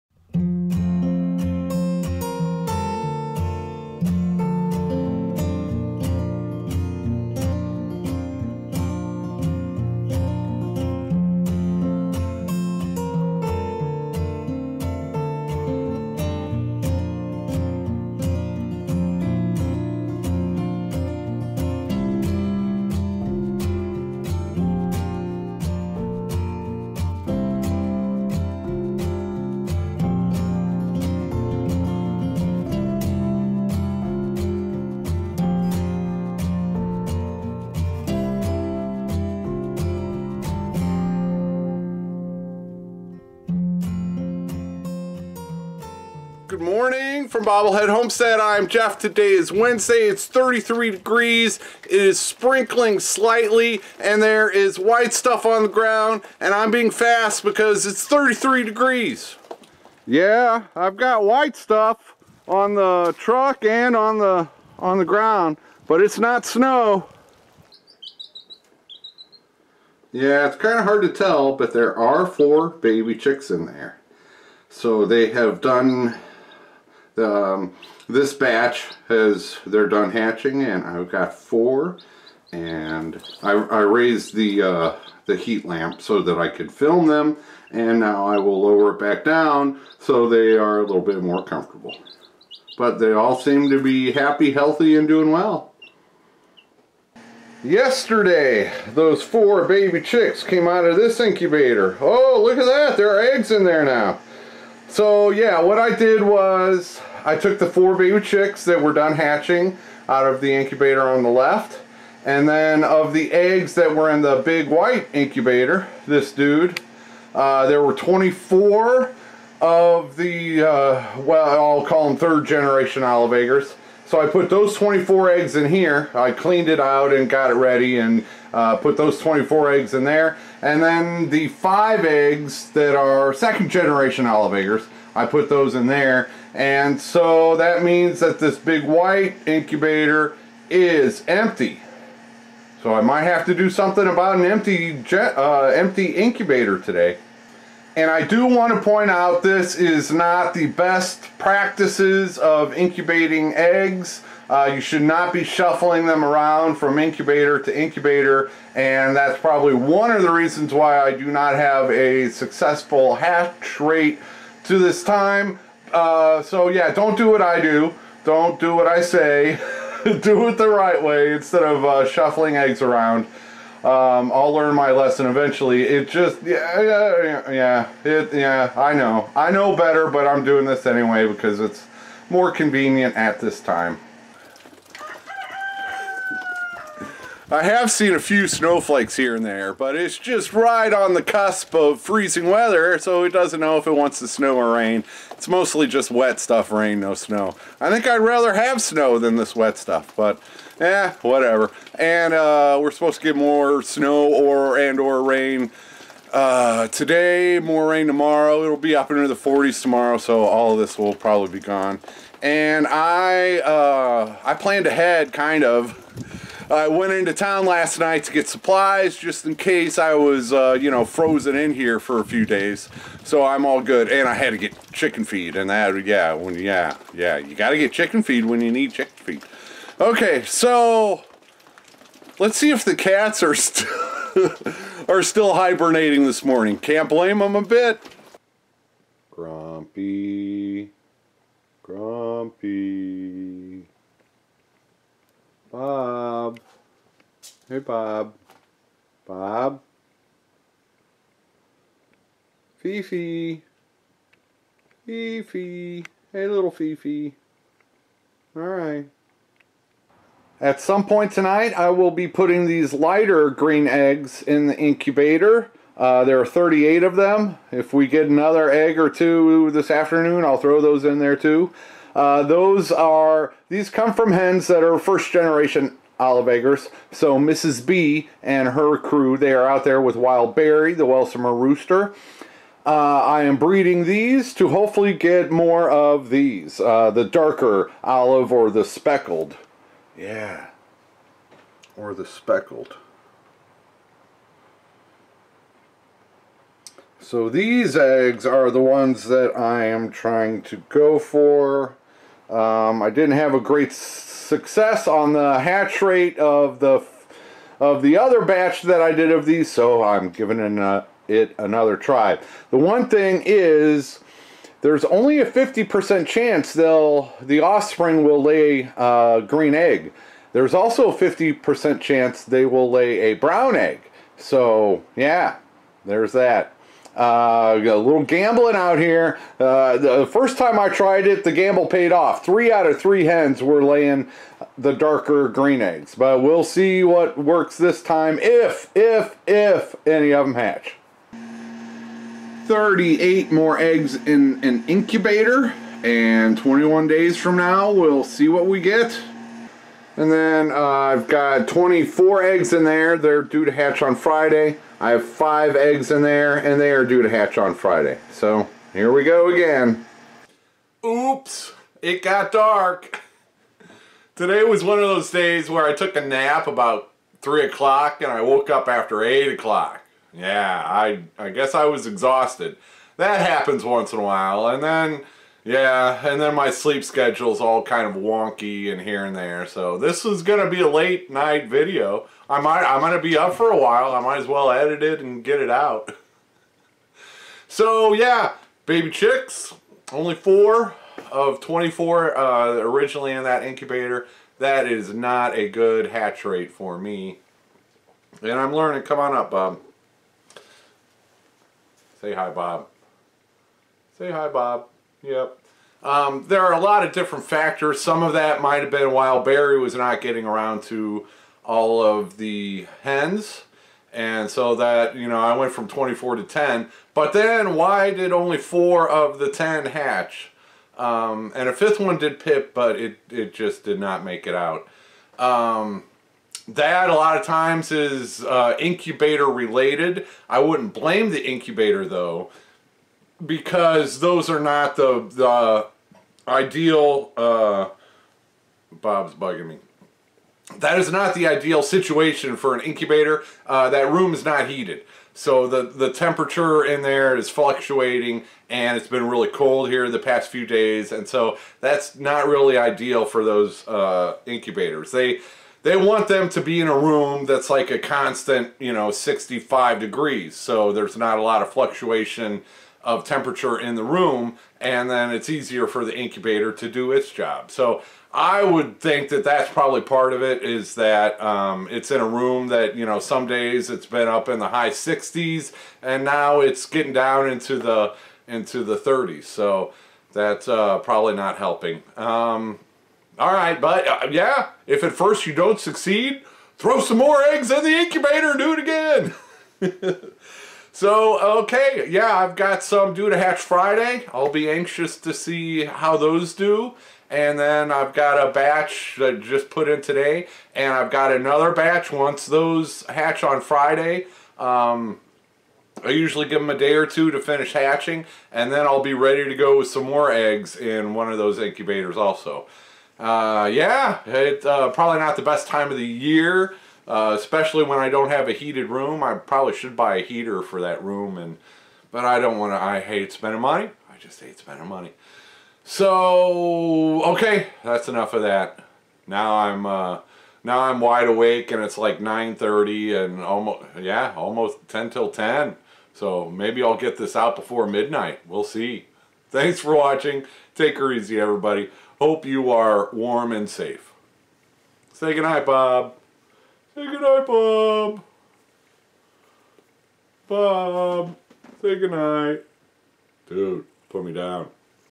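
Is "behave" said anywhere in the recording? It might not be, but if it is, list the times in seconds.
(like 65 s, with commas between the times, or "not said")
not said.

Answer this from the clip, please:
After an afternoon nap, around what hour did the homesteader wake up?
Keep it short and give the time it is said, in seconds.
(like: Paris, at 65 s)
8 o'clock, at 369 s.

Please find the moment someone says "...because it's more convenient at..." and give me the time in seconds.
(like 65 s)
181 s.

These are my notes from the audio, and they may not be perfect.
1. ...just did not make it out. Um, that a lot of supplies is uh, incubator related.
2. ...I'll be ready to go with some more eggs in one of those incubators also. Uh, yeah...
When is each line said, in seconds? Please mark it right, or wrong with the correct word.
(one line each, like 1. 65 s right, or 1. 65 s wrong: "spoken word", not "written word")
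1. 423 s wrong: "times", not "supplies"
2. 508 s right.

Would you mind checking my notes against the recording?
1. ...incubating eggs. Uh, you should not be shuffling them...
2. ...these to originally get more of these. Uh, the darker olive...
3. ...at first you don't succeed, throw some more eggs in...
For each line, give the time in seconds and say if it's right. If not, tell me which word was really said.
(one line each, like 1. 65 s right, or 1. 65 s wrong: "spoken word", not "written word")
1. 152 s right
2. 284 s wrong: "hopefully", not "originally"
3. 485 s right.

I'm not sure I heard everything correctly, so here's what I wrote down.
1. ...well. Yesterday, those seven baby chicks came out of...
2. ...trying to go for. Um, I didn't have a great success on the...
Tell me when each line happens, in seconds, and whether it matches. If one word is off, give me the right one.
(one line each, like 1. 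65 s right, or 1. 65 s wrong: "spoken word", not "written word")
1. 95 s wrong: "four", not "seven"
2. 300 s right.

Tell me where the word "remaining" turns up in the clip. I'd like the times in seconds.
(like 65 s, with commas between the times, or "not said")
not said.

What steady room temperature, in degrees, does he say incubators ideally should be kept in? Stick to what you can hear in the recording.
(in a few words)
65.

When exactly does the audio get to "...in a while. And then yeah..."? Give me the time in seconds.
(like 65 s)
374 s.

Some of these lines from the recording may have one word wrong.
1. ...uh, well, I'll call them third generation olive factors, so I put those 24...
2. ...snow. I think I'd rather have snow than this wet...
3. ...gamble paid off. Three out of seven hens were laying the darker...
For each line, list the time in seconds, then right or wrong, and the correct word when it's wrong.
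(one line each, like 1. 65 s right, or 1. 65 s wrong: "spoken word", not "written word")
1. 120 s wrong: "eggers", not "factors"
2. 197 s right
3. 331 s wrong: "three", not "seven".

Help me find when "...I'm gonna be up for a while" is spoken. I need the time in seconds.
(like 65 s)
382 s.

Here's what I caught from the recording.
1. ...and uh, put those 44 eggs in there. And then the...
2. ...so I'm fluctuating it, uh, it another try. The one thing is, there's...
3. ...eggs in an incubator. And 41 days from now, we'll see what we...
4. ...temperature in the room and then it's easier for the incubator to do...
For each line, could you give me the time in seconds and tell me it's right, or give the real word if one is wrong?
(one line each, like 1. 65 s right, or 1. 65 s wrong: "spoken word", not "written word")
1. 127 s wrong: "24", not "44"
2. 309 s wrong: "giving", not "fluctuating"
3. 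343 s wrong: "21", not "41"
4. 463 s right.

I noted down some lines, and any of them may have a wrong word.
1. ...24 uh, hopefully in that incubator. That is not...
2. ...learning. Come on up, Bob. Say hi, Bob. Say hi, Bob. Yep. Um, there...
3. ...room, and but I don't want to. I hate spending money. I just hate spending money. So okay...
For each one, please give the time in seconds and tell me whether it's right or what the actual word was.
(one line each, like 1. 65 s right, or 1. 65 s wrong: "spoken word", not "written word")
1. 391 s wrong: "originally", not "hopefully"
2. 398 s right
3. 521 s right.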